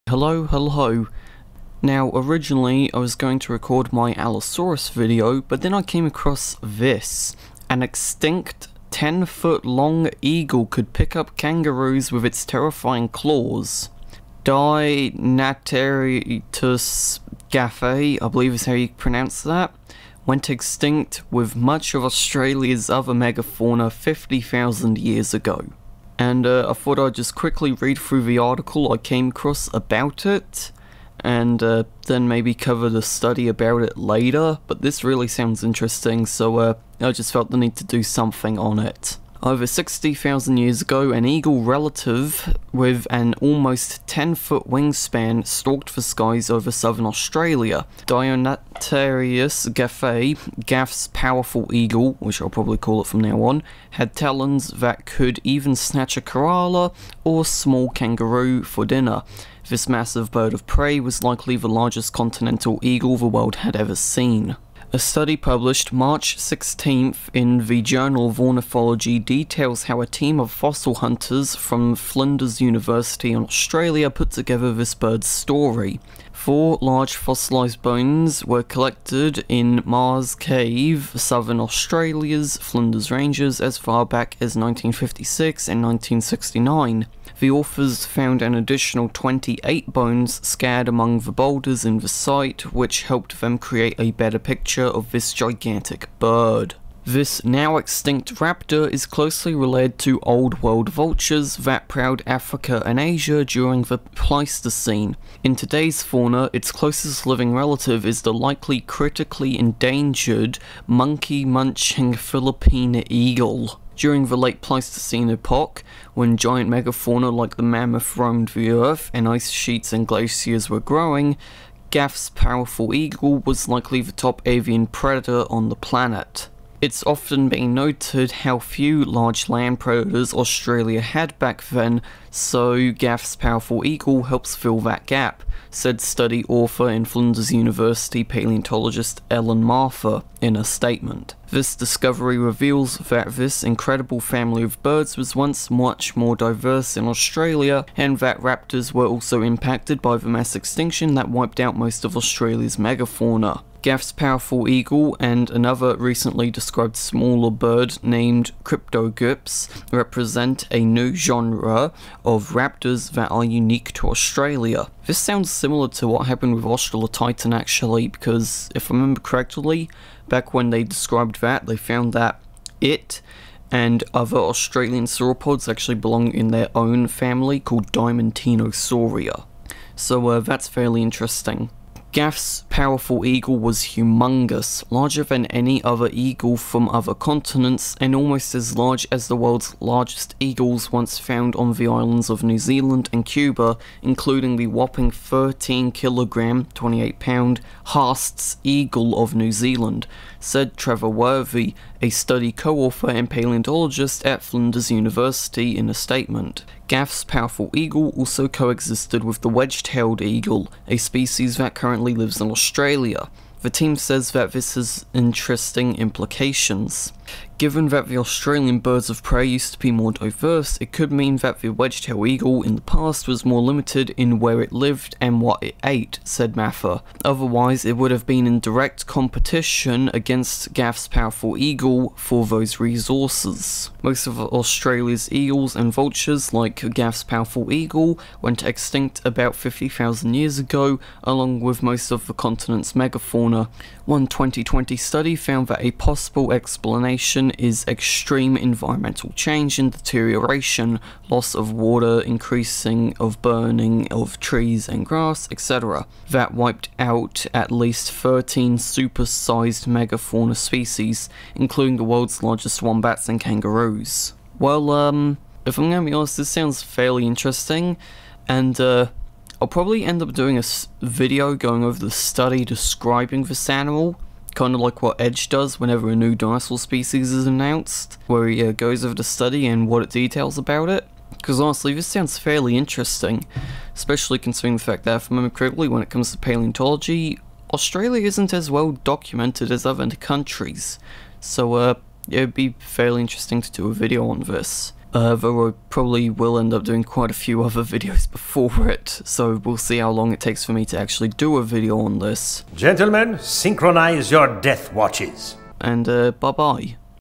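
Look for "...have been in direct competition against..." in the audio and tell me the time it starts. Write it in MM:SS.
03:48.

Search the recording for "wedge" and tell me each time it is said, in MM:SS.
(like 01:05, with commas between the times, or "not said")
03:29, 03:41.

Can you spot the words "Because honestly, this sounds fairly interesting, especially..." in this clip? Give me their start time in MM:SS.
04:41.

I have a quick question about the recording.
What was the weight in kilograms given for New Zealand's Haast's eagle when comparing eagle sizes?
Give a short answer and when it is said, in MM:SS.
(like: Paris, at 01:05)
13 kilograms, at 03:15.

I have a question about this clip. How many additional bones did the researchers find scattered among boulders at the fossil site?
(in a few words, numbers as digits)
28.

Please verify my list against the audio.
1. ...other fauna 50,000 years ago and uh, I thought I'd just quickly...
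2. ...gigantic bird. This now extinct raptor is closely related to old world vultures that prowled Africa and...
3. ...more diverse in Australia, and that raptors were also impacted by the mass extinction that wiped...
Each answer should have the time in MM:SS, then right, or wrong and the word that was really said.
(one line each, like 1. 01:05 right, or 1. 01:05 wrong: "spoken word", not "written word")
1. 00:22 wrong: "megafauna", not "fauna"
2. 01:35 right
3. 02:26 right.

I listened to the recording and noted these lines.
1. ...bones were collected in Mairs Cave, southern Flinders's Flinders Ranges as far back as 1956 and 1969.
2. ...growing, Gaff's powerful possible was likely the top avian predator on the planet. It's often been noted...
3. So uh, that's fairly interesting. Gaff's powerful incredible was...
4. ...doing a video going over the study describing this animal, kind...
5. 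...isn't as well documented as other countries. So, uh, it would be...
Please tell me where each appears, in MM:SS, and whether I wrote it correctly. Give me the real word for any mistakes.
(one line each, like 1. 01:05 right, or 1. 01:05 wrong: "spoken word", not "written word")
1. 01:17 wrong: "Australia", not "Flinders"
2. 02:00 wrong: "eagle", not "possible"
3. 02:59 wrong: "eagle", not "incredible"
4. 04:30 right
5. 04:48 right.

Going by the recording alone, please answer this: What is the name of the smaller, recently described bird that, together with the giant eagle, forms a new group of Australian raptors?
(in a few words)
Cryptogyps.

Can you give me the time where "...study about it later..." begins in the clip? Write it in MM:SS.
00:33.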